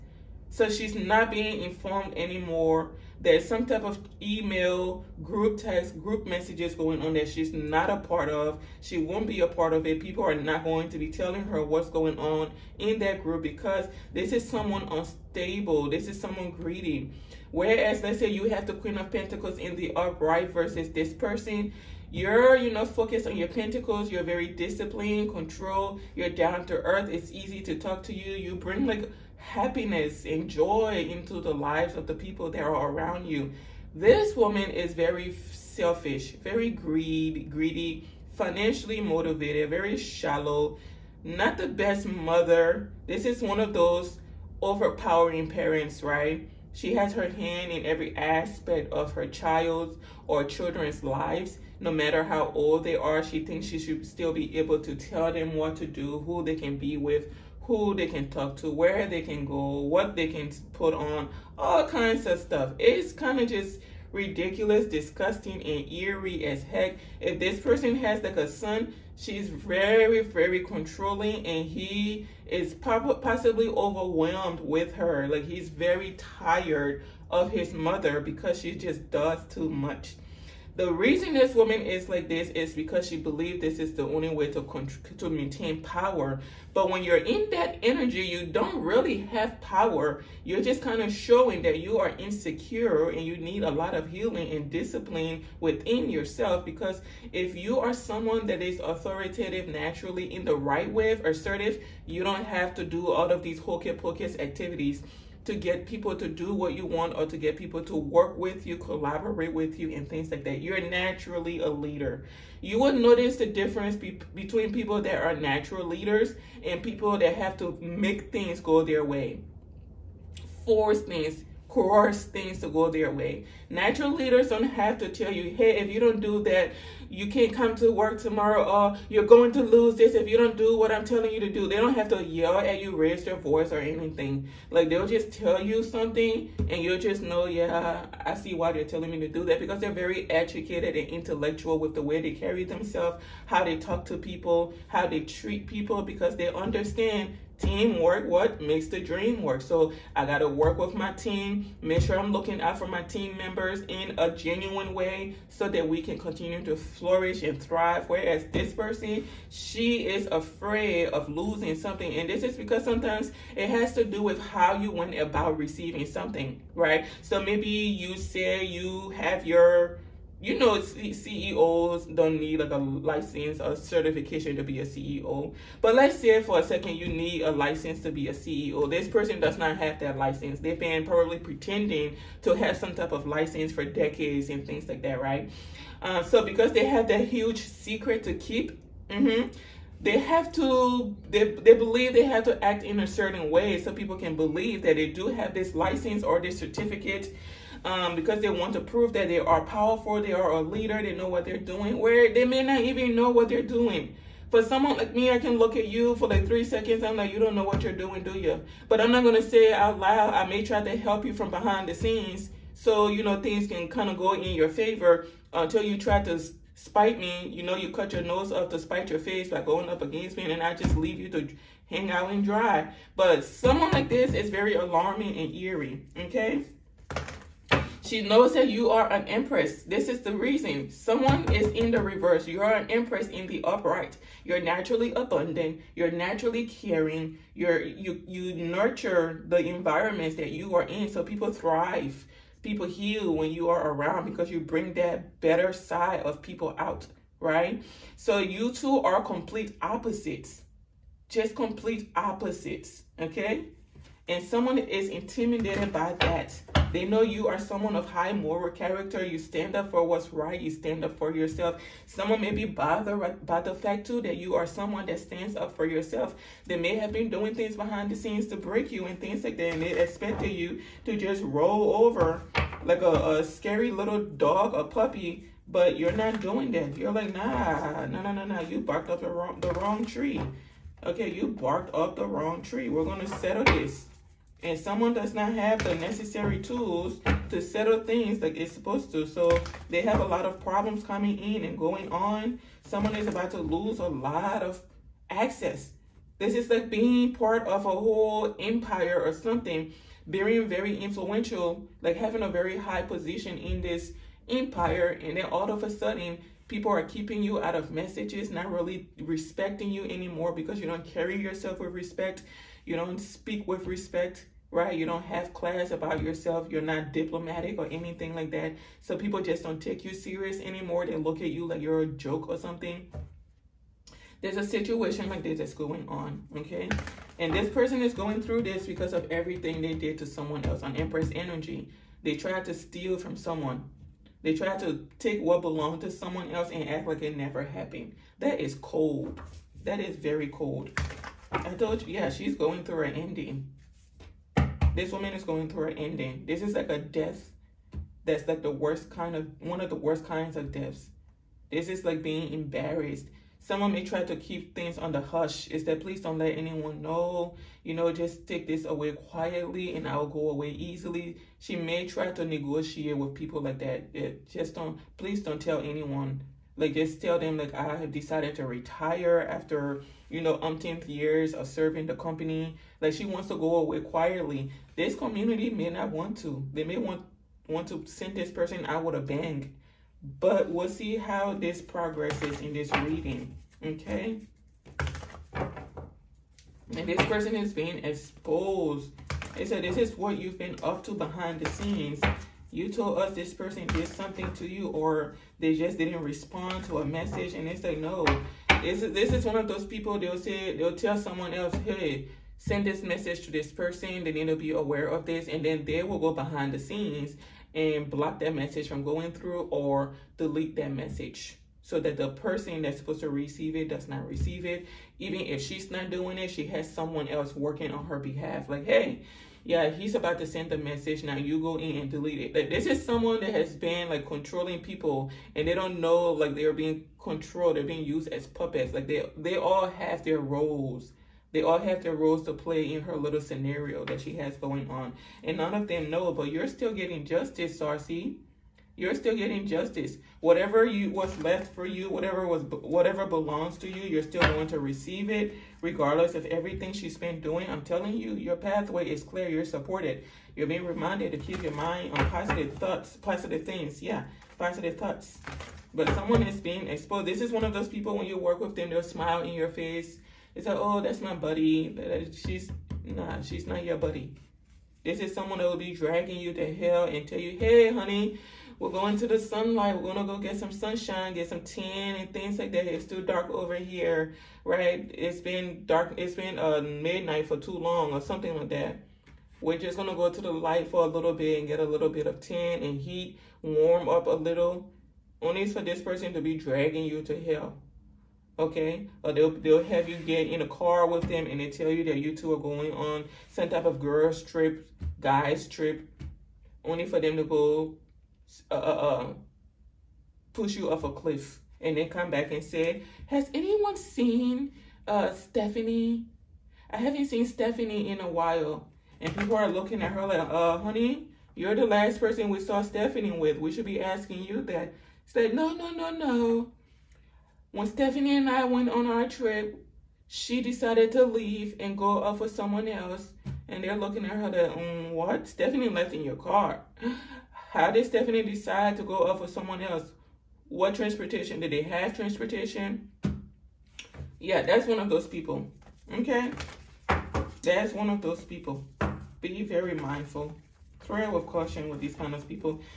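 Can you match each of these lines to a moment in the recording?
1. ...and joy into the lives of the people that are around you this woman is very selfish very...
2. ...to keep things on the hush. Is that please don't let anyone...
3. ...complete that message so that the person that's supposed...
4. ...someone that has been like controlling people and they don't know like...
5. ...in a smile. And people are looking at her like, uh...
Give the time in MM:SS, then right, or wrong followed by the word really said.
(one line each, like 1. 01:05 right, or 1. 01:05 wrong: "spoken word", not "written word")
1. 00:30 right
2. 05:54 right
3. 06:50 wrong: "delete", not "complete"
4. 07:03 right
5. 08:28 wrong: "while", not "smile".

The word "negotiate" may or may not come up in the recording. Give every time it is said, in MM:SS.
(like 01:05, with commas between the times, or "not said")
06:02.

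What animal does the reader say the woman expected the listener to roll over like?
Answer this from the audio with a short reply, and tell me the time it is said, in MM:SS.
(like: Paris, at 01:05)
A puppy, at 04:34.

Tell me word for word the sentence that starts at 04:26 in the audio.
They may have been doing things behind the scenes to break you and things like that.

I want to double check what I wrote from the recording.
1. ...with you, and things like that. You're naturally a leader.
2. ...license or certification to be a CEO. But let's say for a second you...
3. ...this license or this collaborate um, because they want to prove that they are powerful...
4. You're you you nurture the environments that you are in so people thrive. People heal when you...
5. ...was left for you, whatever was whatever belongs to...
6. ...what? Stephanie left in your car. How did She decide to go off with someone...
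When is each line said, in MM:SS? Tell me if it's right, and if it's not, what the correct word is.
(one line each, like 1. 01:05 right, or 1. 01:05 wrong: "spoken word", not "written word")
1. 01:49 right
2. 02:52 right
3. 03:15 wrong: "certificate", not "collaborate"
4. 03:57 right
5. 07:21 right
6. 08:45 wrong: "Stephanie", not "She".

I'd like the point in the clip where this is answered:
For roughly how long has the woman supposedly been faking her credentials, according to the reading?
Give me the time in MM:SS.
03:03.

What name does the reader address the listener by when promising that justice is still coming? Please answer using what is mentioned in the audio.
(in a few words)
Sarcy.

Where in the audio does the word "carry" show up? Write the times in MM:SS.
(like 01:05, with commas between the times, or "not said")
02:22, 05:11.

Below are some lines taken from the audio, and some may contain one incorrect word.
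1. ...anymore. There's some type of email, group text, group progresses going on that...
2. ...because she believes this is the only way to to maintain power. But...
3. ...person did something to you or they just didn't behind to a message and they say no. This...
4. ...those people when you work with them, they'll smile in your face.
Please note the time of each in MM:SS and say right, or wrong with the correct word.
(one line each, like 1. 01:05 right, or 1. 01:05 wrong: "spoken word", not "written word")
1. 00:02 wrong: "messages", not "progresses"
2. 01:22 right
3. 06:33 wrong: "respond", not "behind"
4. 07:37 right.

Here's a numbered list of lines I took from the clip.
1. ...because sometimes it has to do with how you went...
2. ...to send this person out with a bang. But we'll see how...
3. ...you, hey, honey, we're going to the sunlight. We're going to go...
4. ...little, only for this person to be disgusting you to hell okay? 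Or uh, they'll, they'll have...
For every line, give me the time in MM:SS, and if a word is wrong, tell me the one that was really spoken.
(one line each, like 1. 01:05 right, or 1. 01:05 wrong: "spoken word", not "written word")
1. 02:42 right
2. 06:17 right
3. 07:47 right
4. 08:04 wrong: "dragging", not "disgusting".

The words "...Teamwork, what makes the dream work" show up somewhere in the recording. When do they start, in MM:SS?
02:27.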